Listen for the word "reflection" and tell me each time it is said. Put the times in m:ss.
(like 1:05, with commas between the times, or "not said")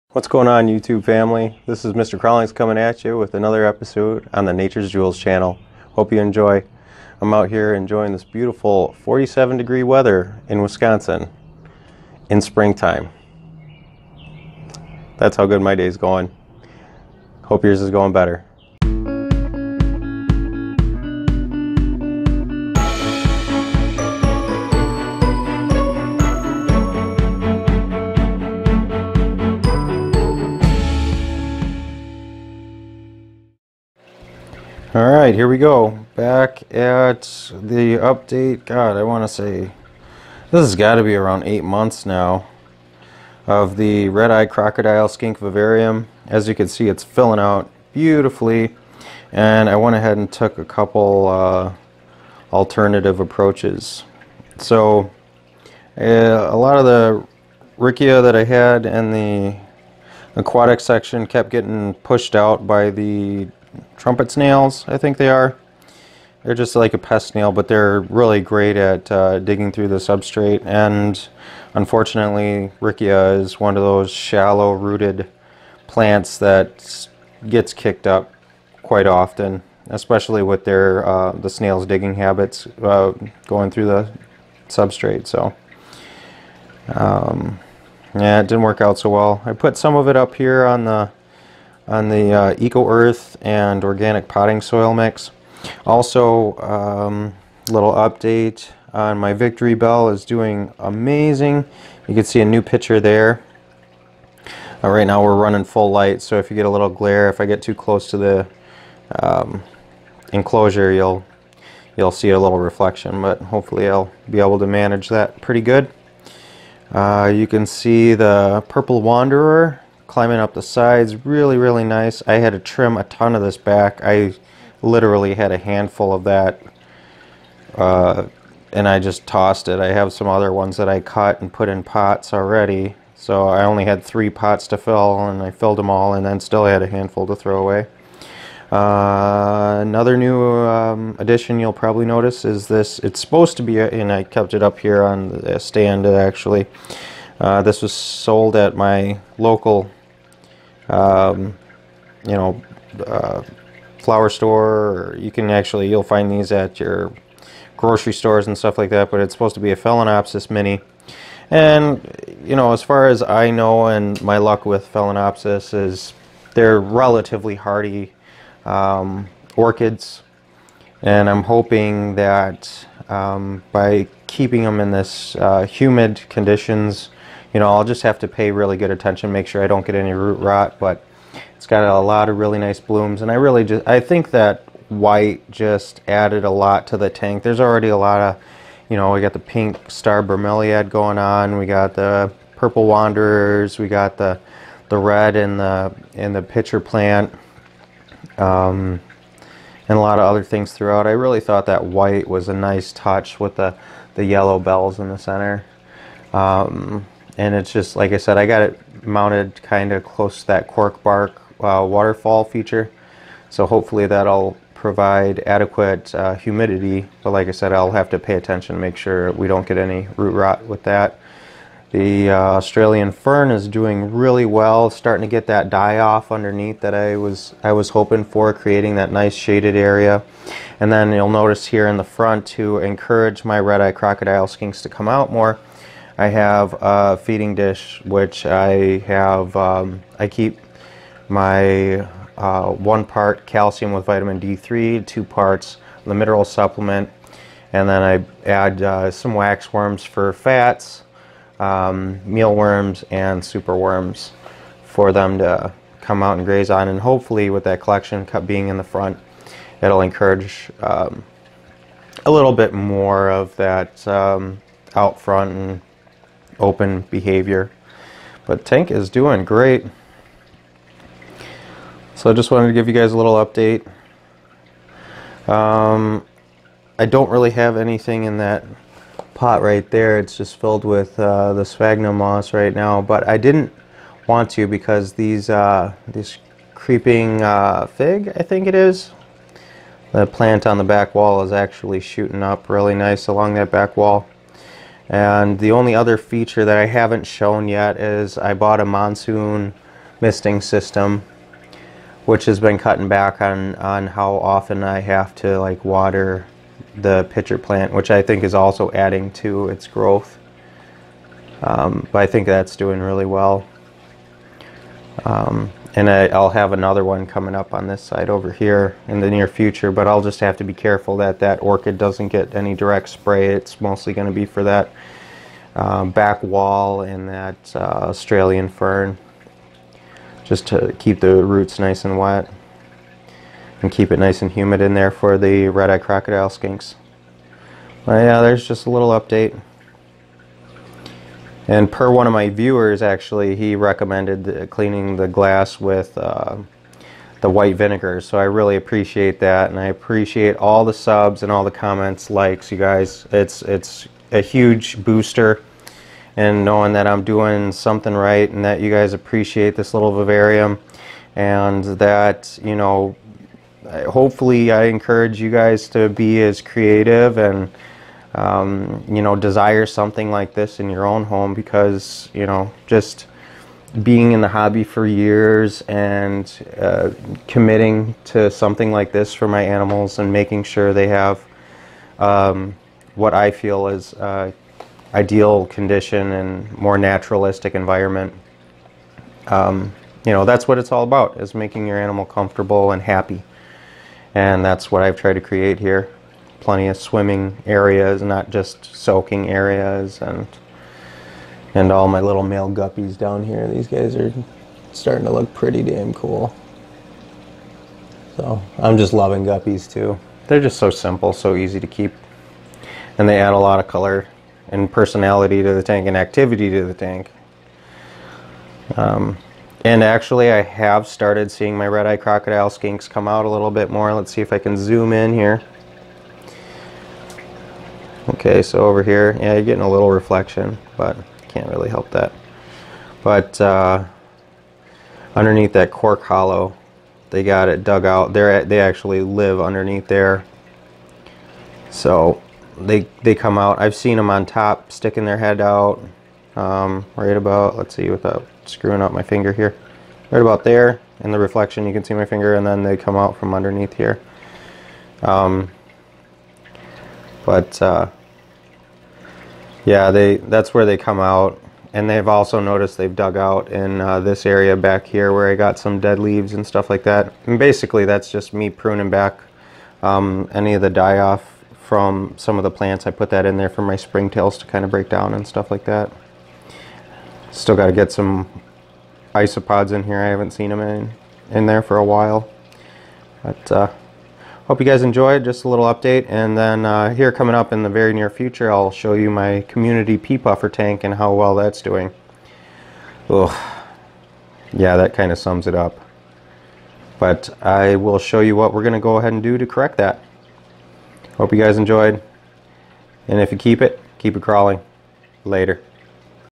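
1:52, 7:10, 7:31.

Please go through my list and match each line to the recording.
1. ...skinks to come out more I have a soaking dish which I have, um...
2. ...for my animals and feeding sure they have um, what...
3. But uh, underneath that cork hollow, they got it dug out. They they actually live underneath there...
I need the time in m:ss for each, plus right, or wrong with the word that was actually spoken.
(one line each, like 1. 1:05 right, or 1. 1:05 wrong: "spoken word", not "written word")
1. 3:54 wrong: "feeding", not "soaking"
2. 6:19 wrong: "making", not "feeding"
3. 7:13 right.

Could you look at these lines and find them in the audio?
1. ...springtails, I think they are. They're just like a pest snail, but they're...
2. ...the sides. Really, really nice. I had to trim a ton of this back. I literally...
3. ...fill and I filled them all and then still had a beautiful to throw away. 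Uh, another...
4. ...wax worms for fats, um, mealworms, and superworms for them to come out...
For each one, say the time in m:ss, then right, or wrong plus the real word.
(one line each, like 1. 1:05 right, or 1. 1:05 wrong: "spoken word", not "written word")
1. 1:04 wrong: "snails", not "springtails"
2. 2:00 right
3. 2:14 wrong: "handful", not "beautiful"
4. 4:09 right.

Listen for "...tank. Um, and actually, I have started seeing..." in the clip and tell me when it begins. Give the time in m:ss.
6:56.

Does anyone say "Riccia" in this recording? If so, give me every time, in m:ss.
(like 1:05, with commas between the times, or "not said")
0:57, 1:12.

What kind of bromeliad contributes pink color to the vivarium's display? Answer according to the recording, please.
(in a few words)
pink star bromeliad.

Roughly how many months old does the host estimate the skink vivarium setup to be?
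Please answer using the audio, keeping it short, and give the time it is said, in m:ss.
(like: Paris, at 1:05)
8 months, at 0:41.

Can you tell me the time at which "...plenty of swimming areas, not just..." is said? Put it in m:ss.
6:36.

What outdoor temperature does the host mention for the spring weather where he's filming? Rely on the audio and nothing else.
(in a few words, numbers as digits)
47 degrees.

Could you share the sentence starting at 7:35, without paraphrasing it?
Um, but uh, yeah, they that's where they come out.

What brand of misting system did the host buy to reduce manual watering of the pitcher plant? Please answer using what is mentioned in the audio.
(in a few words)
Monsoon.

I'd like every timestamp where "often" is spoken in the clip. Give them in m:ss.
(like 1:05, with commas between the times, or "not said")
1:19, 5:04.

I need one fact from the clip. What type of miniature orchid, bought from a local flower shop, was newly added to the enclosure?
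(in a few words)
Phalaenopsis mini.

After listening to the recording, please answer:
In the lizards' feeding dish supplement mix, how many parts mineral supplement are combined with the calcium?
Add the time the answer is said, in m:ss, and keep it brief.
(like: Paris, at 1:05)
2 parts, at 4:05.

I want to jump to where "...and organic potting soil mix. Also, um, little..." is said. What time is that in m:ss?
1:33.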